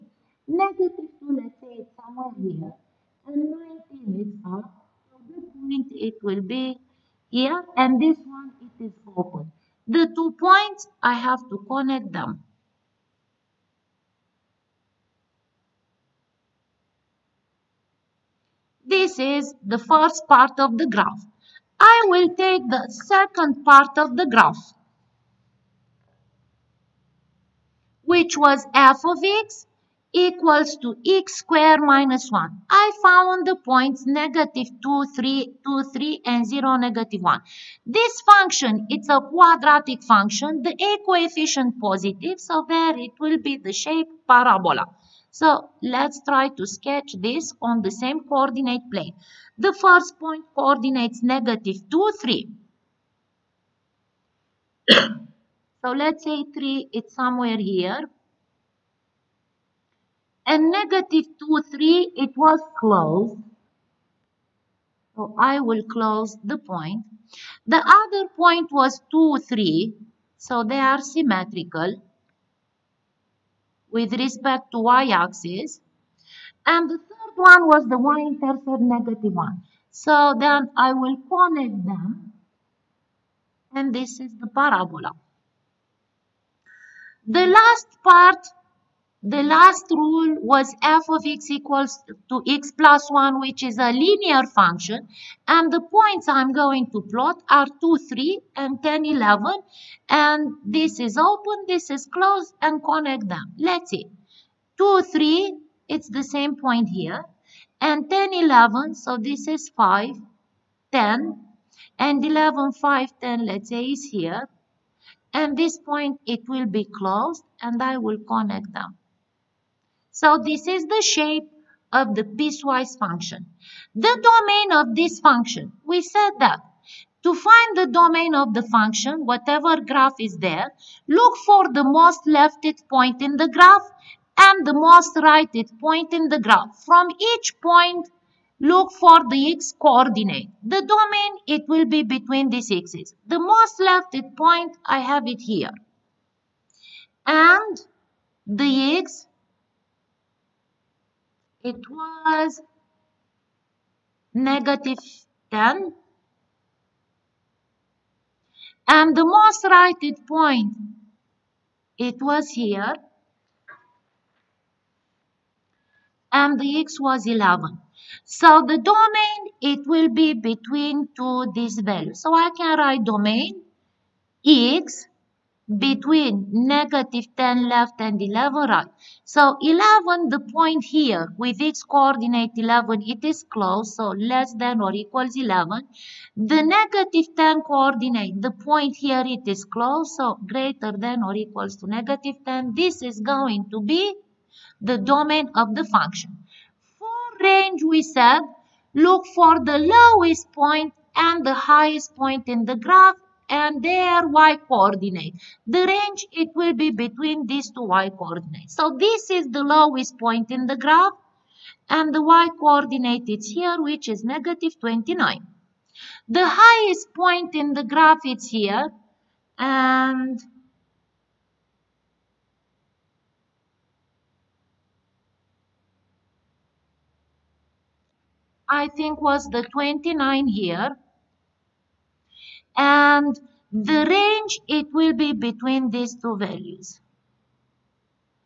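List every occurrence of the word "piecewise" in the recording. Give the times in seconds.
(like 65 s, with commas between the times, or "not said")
122 s.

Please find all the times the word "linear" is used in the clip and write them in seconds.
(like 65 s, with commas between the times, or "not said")
93 s.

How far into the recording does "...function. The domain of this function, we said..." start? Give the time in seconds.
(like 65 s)
122 s.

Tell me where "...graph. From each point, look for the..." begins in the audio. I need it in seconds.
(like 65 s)
136 s.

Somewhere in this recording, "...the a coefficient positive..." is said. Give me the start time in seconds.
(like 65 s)
40 s.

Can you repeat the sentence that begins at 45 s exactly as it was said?
So let's try to sketch this on the same coordinate plane.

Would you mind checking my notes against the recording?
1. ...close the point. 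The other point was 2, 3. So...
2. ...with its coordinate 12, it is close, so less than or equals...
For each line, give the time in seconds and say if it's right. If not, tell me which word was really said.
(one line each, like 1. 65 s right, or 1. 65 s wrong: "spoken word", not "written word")
1. 65 s right
2. 181 s wrong: "11", not "12".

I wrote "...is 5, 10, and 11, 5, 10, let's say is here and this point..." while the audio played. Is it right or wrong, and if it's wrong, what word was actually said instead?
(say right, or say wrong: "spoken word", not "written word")
right.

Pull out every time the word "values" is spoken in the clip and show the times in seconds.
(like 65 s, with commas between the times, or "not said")
171 s, 236 s.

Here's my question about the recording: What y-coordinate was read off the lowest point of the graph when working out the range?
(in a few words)
-29.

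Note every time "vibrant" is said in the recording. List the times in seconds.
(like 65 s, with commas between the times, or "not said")
not said.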